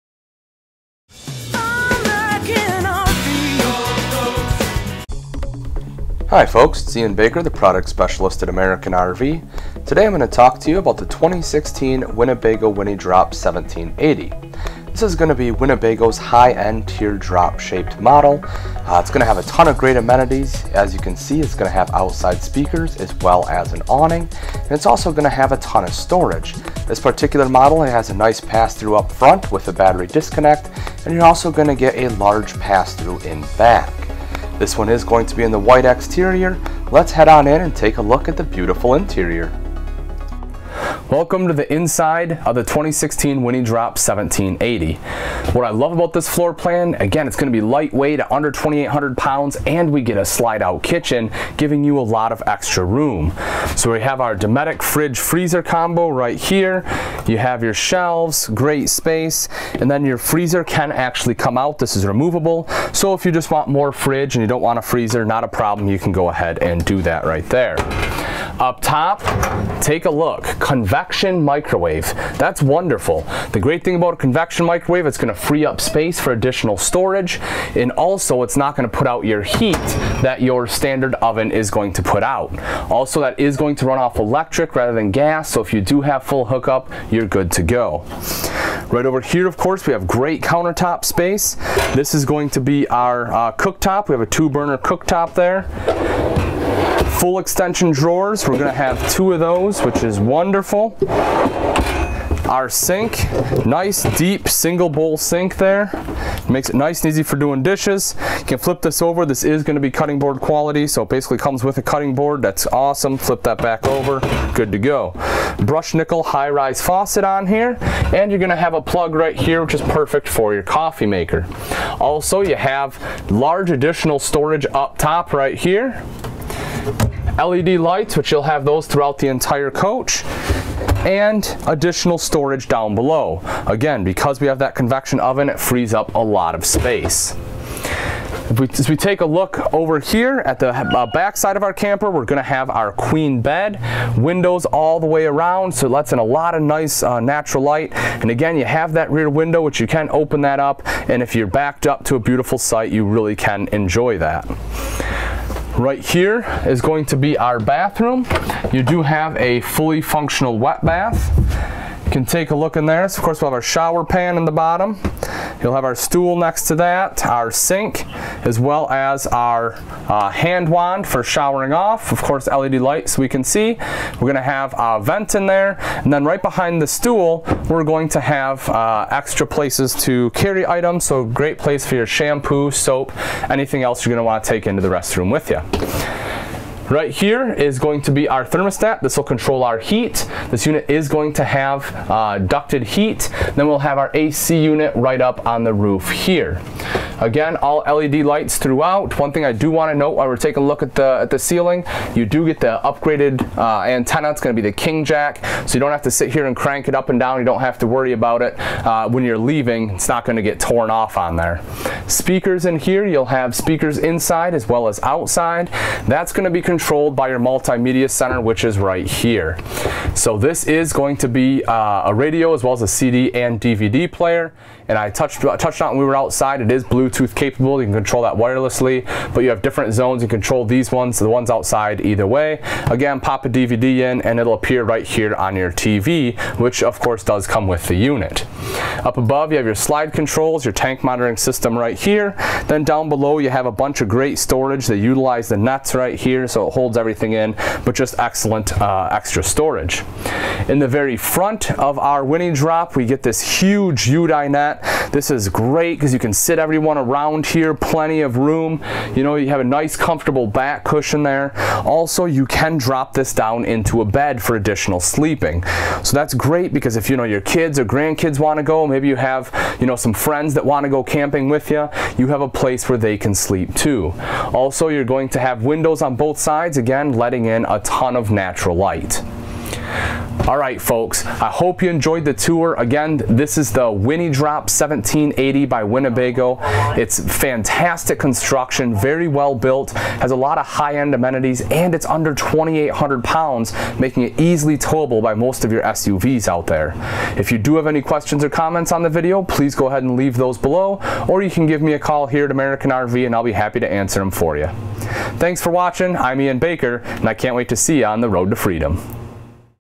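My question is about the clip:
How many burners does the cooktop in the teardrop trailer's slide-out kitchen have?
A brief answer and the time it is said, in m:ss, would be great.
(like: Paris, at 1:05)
2, at 1:34.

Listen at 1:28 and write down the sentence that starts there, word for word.
Right over here, of course, we have great countertop space.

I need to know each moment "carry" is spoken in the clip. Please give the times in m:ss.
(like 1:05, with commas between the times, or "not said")
3:00.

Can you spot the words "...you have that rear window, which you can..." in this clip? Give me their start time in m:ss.
2:28.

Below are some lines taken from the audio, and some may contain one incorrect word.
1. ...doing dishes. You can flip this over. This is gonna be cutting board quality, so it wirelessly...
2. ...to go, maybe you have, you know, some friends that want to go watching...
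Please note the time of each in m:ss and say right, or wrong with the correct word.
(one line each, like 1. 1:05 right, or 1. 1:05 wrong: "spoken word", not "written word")
1. 1:47 wrong: "basically", not "wirelessly"
2. 4:28 wrong: "camping", not "watching".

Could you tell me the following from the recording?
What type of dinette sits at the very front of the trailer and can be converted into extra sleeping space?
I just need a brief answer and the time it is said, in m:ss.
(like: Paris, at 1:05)
UDI dinette, at 4:14.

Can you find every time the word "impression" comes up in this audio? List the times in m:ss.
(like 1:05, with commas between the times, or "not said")
not said.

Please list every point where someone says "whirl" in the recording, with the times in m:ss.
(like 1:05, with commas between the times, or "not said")
not said.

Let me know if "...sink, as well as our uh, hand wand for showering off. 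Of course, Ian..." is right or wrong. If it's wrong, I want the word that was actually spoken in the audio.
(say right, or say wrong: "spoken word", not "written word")
wrong: "LED", not "Ian".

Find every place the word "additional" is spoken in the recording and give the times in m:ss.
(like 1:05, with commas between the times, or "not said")
1:16, 2:03, 2:11, 4:24.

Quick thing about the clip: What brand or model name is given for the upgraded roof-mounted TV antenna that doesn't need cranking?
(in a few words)
King Jack.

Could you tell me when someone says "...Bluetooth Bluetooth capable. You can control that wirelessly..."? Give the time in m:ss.
3:46.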